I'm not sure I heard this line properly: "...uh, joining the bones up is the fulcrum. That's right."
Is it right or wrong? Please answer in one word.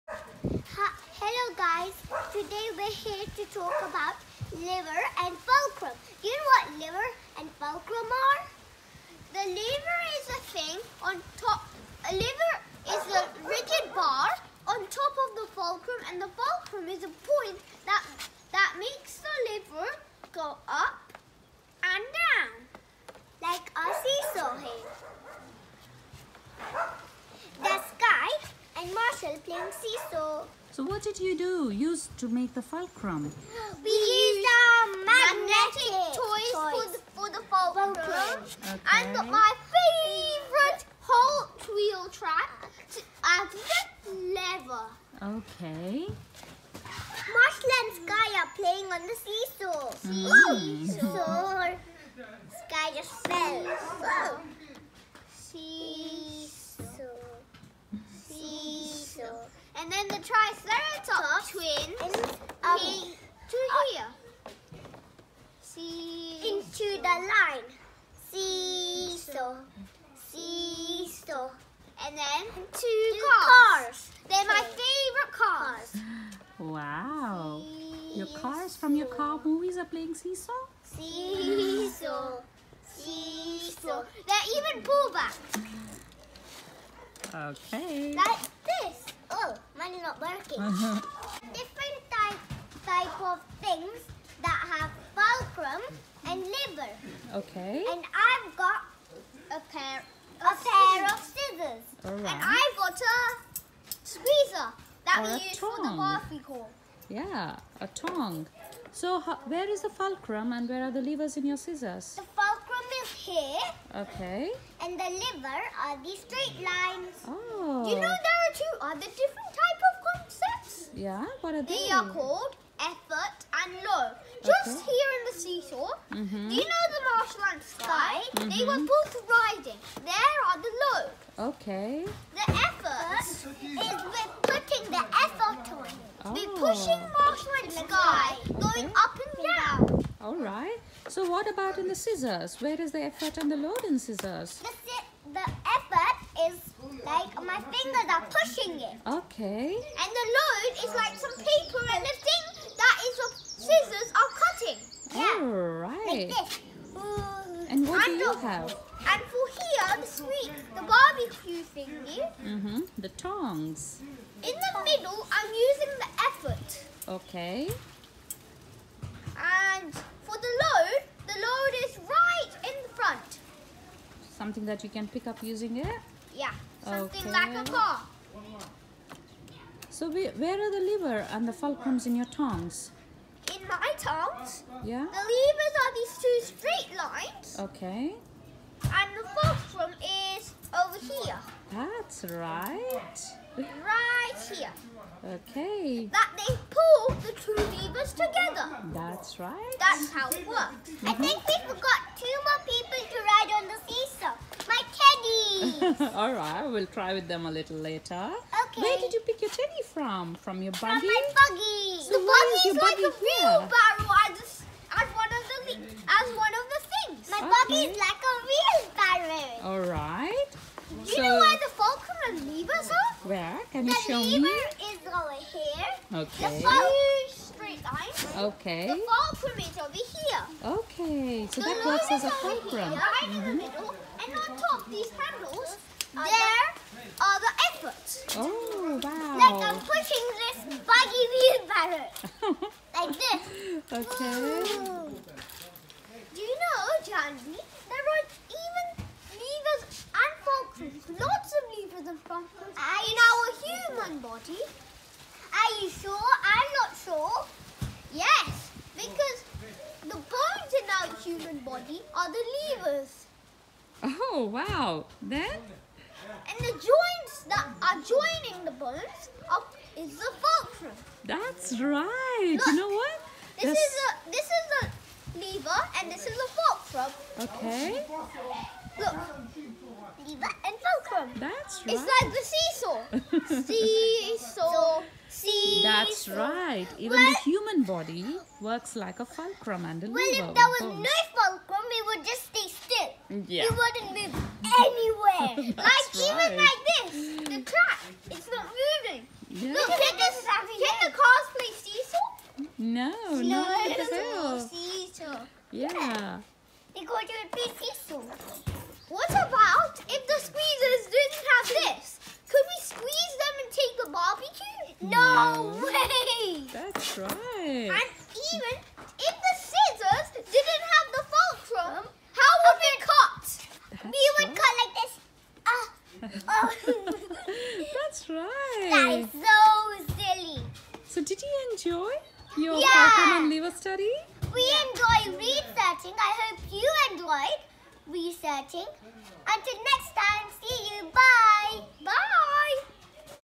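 right.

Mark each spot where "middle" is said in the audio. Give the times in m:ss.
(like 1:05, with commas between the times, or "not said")
2:44, 3:53.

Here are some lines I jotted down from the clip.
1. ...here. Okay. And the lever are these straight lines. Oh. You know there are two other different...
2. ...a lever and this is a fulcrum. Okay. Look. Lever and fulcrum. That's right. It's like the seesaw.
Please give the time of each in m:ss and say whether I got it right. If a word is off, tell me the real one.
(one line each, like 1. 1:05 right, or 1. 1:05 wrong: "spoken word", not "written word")
1. 1:53 right
2. 4:34 right.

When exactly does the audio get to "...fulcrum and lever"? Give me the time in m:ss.
1:35.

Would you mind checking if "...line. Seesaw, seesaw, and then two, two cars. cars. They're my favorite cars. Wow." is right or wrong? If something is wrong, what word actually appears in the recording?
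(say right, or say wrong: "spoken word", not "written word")
right.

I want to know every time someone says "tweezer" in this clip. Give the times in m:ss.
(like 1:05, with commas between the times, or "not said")
1:44.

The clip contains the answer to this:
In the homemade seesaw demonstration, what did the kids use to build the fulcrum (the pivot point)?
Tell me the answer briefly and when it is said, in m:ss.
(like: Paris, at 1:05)
magnetic toys, at 0:35.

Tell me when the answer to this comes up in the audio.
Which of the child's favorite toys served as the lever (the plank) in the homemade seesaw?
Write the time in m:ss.
0:41.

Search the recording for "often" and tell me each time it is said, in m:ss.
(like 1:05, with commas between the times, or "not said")
not said.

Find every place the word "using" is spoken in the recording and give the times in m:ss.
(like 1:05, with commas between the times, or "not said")
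2:45, 2:55.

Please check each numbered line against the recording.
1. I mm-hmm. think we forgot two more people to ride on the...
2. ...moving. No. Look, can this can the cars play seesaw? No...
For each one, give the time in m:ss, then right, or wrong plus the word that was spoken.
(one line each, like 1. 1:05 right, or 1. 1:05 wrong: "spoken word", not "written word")
1. 3:21 right
2. 4:58 right.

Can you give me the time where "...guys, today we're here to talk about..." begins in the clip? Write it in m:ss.
0:01.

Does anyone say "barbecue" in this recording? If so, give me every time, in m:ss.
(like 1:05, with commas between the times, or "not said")
2:40.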